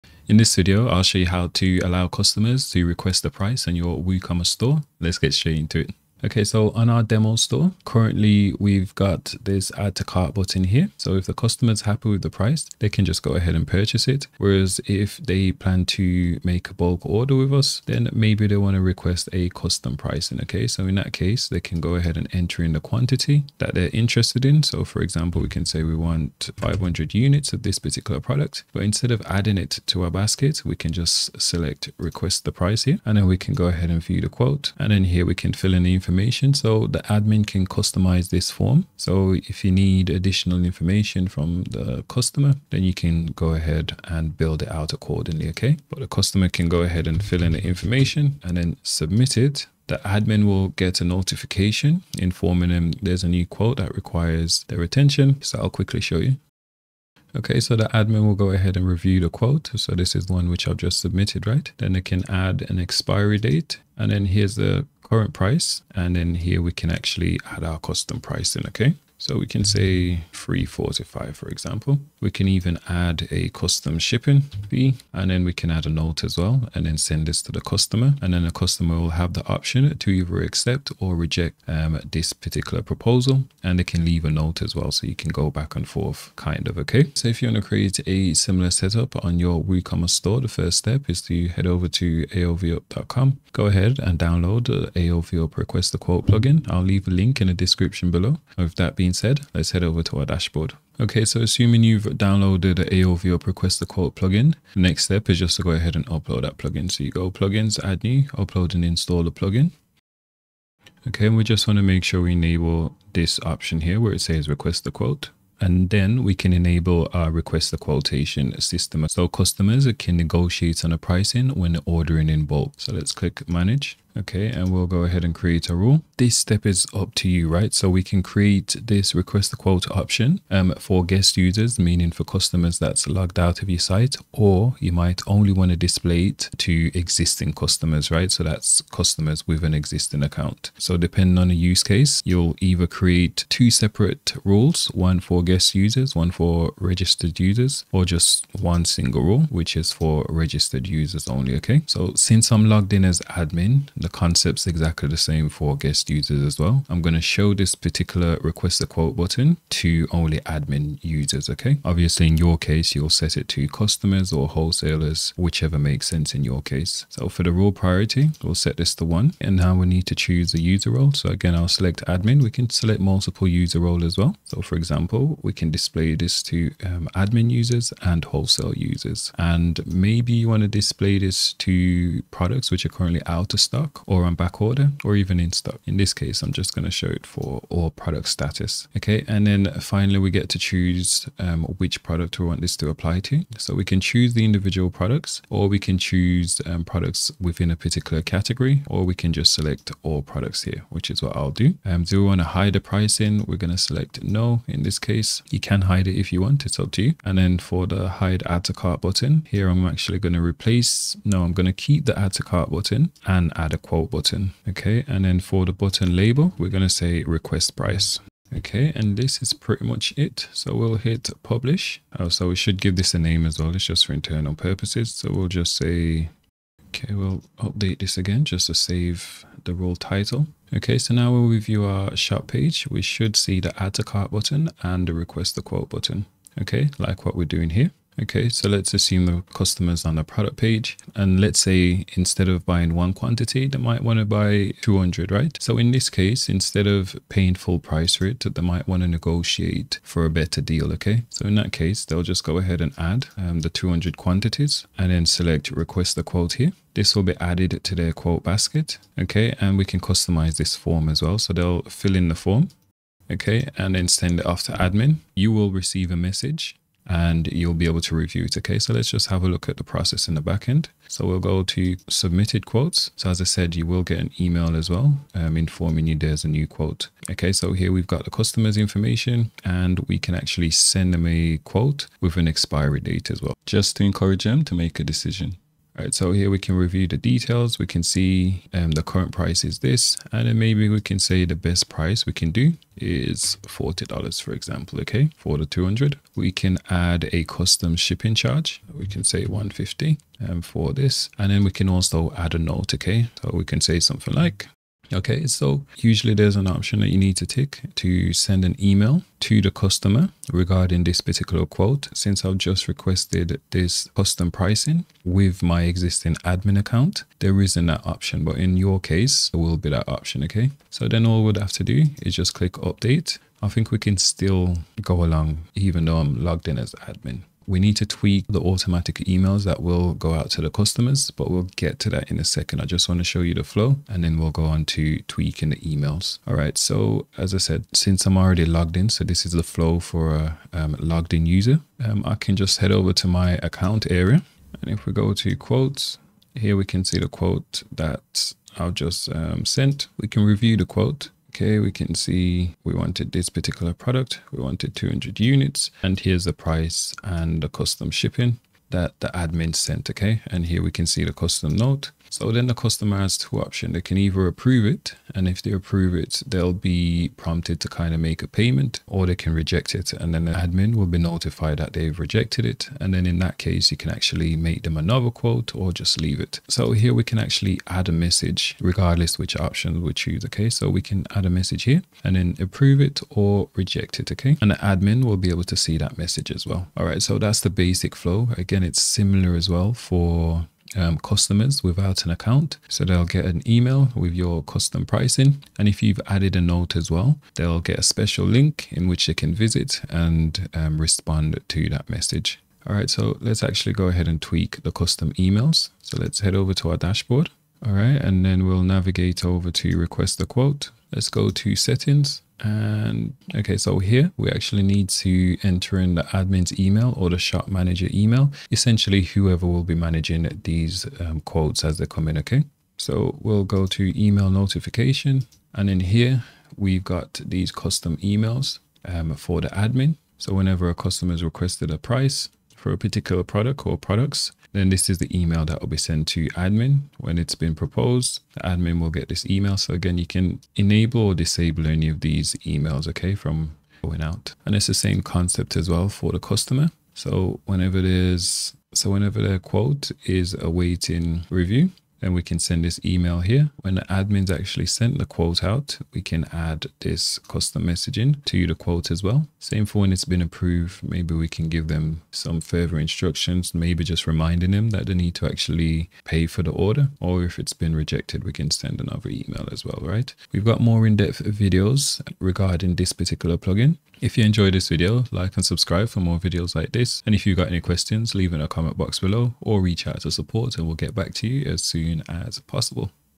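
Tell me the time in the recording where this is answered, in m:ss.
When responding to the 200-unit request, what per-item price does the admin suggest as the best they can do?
4:53.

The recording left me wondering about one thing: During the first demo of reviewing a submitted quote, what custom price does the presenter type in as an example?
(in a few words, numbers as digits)
345.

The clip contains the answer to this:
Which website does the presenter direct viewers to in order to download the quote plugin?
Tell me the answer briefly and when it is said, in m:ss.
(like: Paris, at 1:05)
aovup.com, at 1:32.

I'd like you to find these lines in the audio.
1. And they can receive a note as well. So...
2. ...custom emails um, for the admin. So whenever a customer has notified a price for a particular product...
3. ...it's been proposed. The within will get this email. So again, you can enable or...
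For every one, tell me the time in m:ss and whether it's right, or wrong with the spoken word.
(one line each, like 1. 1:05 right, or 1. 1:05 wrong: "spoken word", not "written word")
1. 1:23 wrong: "leave", not "receive"
2. 7:07 wrong: "requested", not "notified"
3. 7:17 wrong: "admin", not "within".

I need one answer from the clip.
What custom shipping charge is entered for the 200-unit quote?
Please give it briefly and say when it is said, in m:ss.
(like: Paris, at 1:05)
150, at 4:59.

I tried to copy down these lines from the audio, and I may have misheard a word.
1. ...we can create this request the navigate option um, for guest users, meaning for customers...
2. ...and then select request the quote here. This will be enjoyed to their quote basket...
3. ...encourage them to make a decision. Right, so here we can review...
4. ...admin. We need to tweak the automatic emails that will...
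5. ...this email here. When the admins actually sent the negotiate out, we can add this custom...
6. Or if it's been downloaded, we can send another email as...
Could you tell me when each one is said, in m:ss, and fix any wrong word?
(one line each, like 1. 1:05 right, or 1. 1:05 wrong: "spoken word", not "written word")
1. 2:07 wrong: "quote", not "navigate"
2. 4:14 wrong: "added", not "enjoyed"
3. 4:44 right
4. 5:27 right
5. 7:32 wrong: "quote", not "negotiate"
6. 7:47 wrong: "rejected", not "downloaded".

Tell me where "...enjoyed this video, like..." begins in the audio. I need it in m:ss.
7:54.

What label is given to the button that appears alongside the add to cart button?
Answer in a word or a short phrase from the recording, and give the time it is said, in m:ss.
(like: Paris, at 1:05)
Request price, at 3:37.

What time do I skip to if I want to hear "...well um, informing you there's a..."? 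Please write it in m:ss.
4:34.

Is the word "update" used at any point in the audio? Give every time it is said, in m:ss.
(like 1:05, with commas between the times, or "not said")
3:47, 5:22.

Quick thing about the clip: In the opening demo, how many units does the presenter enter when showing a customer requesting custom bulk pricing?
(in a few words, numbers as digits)
500.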